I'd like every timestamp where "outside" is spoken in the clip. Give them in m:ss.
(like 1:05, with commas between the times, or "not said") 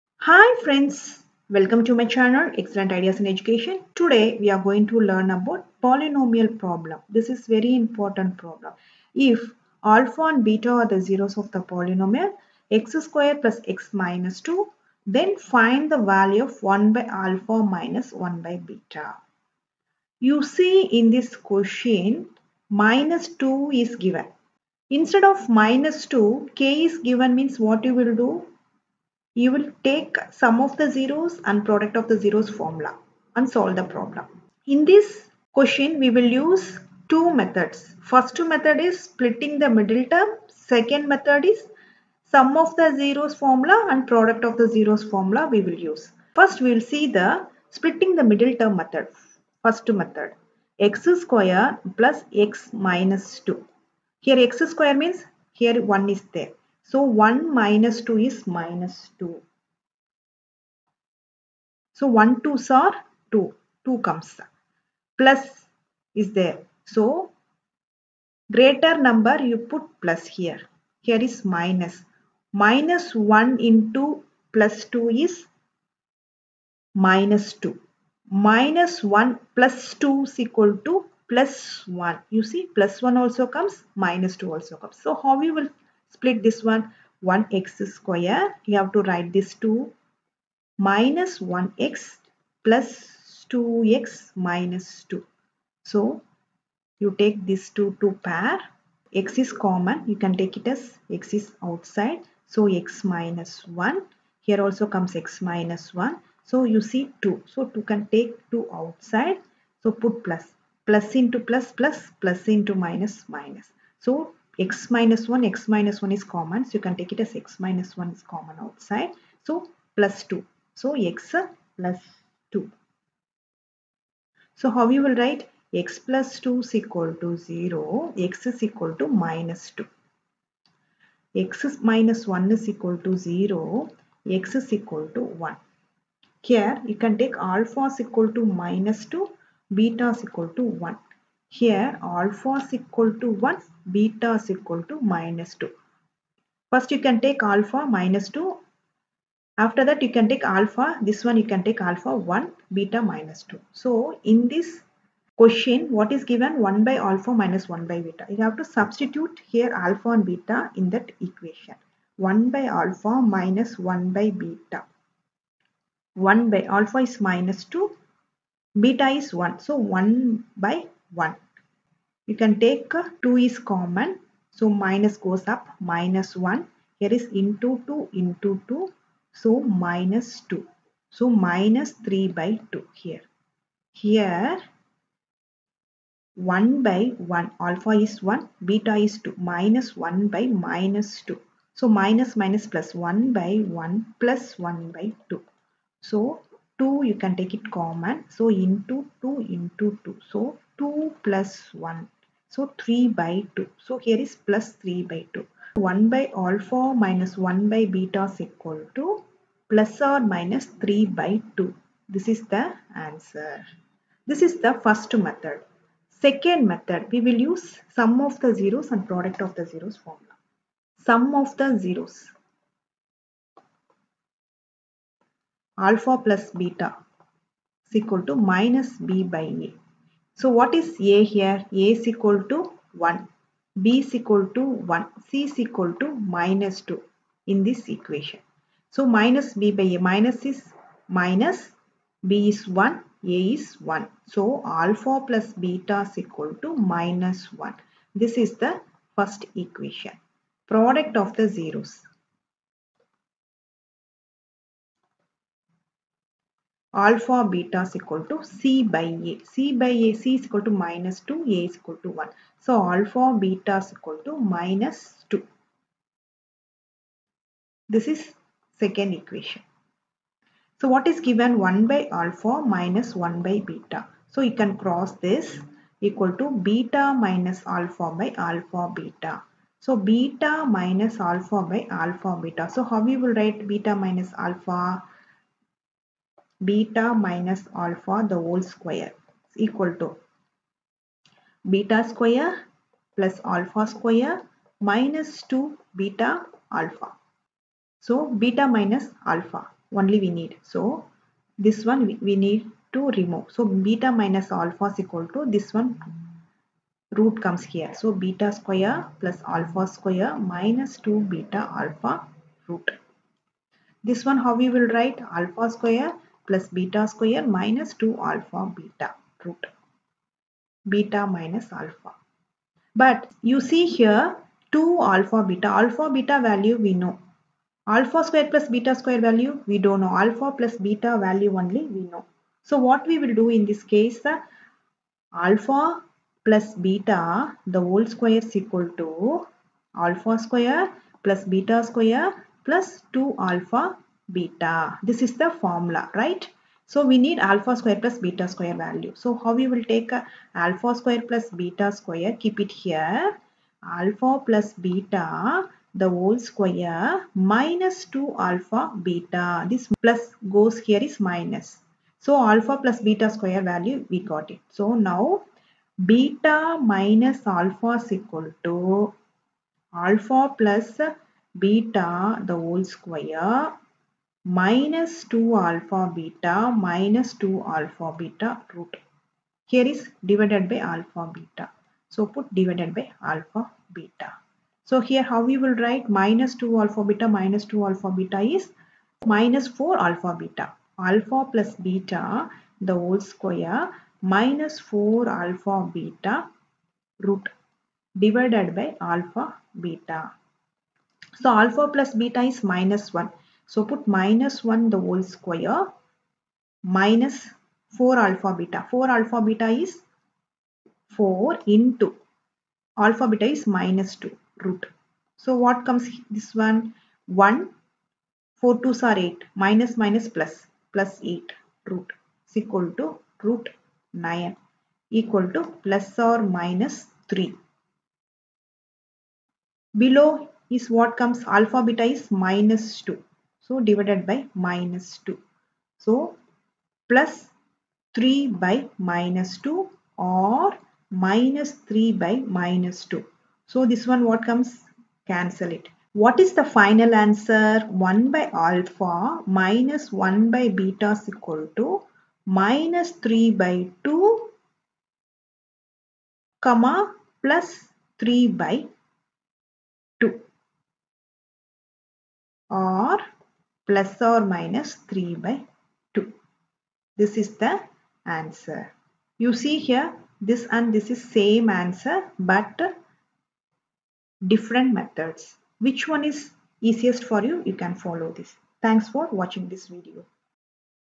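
1:41, 1:48, 1:58.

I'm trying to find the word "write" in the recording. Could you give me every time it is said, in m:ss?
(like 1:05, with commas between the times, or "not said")
1:29, 2:05, 4:43, 5:14, 6:25.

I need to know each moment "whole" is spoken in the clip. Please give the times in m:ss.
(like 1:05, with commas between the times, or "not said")
4:48, 5:37, 5:56, 6:12, 6:32, 6:44.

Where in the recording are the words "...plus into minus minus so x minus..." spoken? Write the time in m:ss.
1:52.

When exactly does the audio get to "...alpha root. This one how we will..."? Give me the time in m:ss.
5:11.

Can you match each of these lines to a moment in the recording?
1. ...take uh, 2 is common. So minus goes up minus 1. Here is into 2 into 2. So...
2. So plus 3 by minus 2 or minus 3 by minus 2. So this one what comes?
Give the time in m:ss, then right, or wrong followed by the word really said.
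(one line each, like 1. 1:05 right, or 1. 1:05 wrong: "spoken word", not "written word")
1. 2:52 right
2. 7:15 right.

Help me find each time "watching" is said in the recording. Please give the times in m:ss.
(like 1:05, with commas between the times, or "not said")
7:59.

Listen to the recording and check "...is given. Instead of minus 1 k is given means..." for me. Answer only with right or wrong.
wrong.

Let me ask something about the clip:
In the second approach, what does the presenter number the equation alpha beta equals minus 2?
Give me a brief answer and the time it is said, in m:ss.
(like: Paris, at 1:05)
Second equation, at 4:28.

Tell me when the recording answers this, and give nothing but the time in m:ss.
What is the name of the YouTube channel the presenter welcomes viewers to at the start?
0:02.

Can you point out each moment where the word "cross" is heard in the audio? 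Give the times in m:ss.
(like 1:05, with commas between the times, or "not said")
4:34.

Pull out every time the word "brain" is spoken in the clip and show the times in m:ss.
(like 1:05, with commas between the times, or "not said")
not said.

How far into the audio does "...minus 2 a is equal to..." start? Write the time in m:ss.
4:20.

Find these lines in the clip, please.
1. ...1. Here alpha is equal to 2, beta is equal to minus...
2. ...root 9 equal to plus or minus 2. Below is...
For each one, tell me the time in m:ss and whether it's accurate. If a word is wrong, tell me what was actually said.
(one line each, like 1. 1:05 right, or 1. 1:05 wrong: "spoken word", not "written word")
1. 2:20 wrong: "1", not "2"
2. 7:03 wrong: "3", not "2".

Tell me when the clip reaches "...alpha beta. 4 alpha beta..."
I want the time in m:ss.
6:48.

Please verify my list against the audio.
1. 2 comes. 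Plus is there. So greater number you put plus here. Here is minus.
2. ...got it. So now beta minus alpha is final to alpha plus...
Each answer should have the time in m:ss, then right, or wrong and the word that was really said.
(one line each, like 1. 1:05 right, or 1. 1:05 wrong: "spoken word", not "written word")
1. 1:03 right
2. 6:04 wrong: "equal", not "final".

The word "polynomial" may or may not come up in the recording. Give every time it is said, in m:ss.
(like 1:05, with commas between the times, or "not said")
0:05, 0:11.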